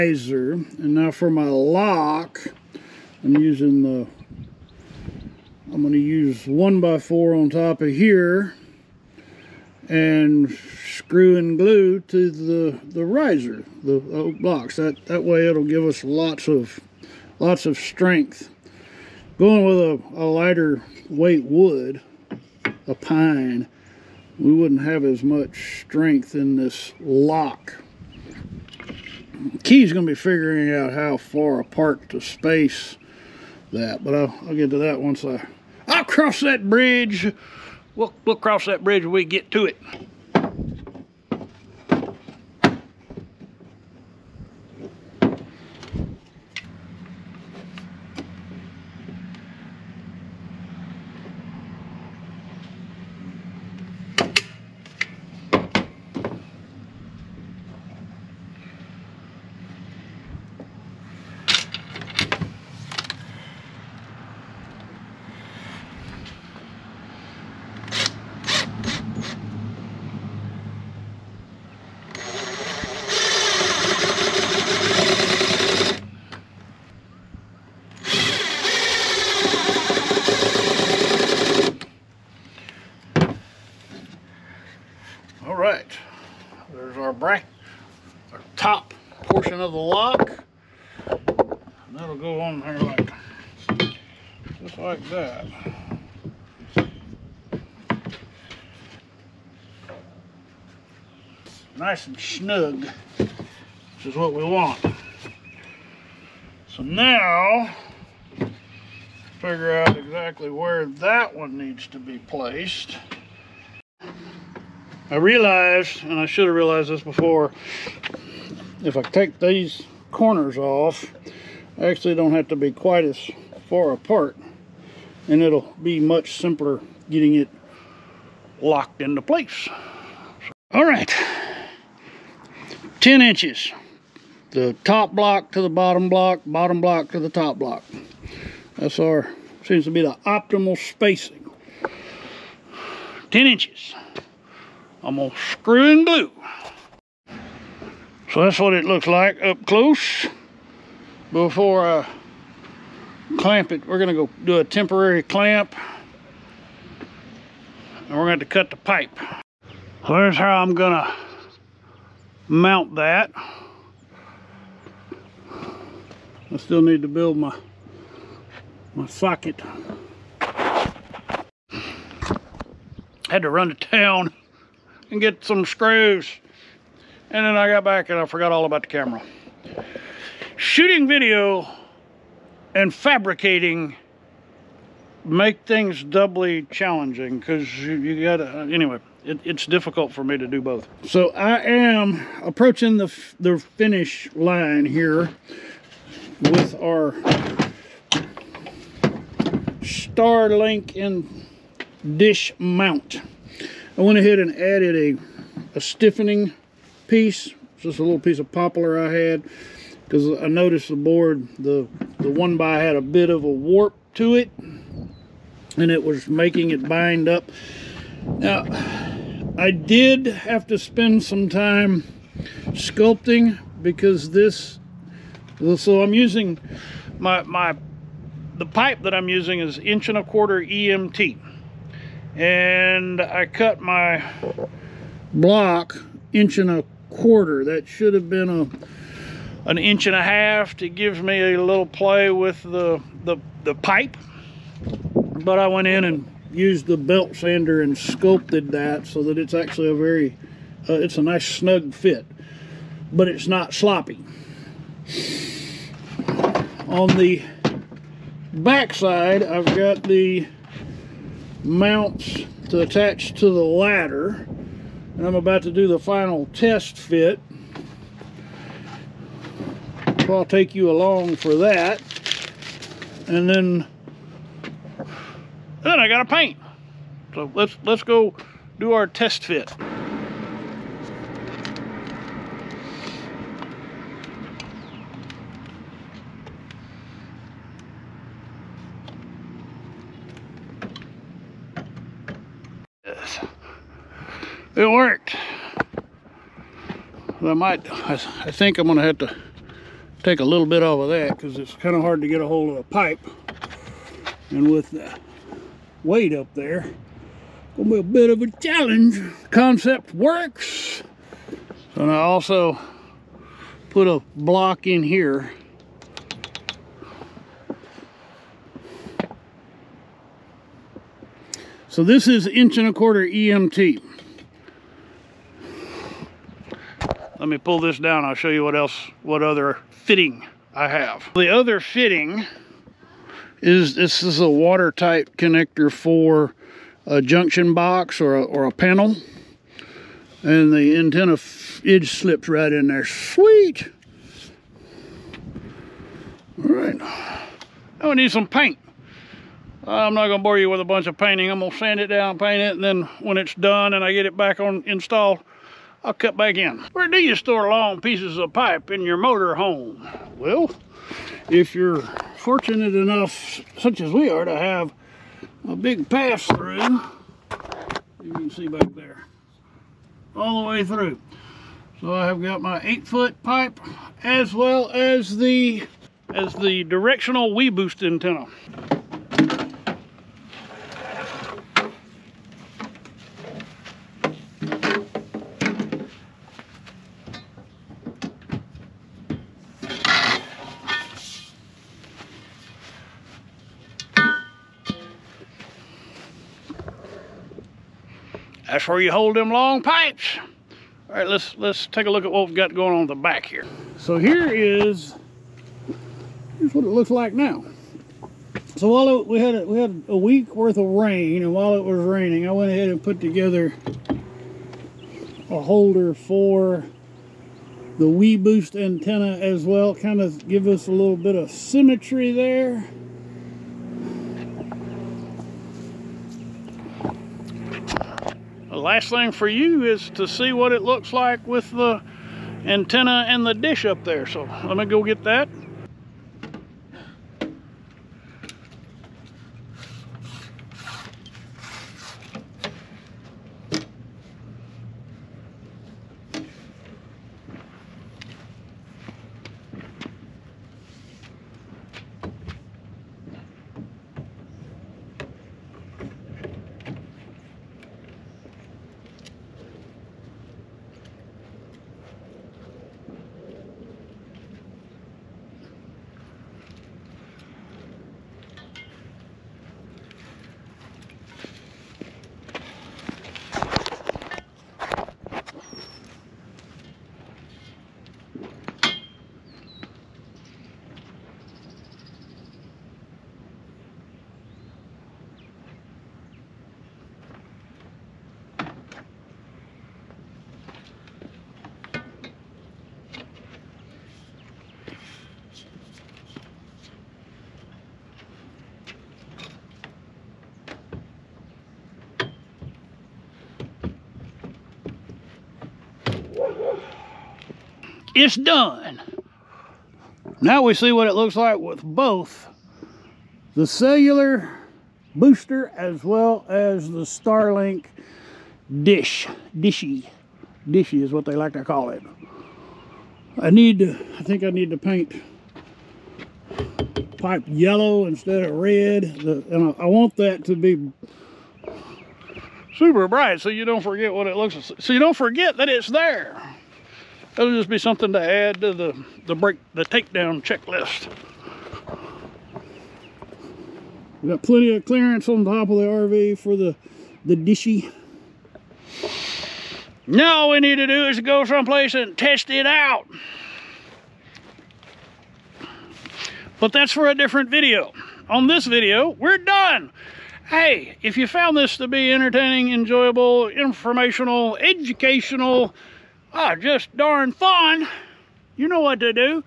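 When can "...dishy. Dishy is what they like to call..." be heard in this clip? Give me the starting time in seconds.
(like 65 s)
519 s.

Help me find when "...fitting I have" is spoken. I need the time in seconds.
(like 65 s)
329 s.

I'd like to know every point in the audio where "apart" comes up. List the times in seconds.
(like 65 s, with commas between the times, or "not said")
31 s, 123 s.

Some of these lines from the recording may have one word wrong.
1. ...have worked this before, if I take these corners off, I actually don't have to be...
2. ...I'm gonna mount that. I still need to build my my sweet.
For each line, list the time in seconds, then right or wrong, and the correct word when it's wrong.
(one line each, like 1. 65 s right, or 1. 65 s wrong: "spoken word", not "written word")
1. 116 s wrong: "realized", not "worked"
2. 160 s wrong: "socket", not "sweet".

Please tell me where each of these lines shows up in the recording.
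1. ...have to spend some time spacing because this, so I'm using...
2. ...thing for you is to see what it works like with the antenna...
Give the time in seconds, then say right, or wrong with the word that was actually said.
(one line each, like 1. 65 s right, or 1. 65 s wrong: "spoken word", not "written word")
1. 220 s wrong: "sculpting", not "spacing"
2. 429 s wrong: "looks", not "works".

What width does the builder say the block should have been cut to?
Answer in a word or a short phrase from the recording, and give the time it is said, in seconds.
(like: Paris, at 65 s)
1.5 inches, at 239 s.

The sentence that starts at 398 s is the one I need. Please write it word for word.
where you hold them long pipes.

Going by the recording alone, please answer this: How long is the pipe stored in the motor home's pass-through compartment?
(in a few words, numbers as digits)
8 feet.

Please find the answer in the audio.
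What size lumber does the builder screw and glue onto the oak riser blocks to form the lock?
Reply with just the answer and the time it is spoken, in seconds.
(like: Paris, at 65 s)
1x4, at 6 s.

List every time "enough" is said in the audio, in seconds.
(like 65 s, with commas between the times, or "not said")
362 s.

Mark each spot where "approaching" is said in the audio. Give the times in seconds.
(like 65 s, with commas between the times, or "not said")
192 s.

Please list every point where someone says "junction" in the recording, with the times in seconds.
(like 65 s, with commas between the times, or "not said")
337 s.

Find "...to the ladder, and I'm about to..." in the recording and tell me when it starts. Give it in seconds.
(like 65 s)
263 s.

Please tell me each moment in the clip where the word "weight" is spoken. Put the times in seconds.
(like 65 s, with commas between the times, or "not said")
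21 s, 306 s.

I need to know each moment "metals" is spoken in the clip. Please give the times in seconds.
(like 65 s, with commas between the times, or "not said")
not said.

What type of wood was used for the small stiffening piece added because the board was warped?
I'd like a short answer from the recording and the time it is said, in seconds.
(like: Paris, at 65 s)
Poplar, at 208 s.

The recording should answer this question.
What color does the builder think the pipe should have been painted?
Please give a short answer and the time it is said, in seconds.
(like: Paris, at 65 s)
Yellow, at 527 s.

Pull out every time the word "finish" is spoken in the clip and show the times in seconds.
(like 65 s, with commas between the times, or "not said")
193 s.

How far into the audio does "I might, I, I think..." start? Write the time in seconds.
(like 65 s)
297 s.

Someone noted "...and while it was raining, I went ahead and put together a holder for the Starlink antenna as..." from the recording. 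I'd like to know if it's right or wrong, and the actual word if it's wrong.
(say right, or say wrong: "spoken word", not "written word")
wrong: "WeBoost", not "Starlink".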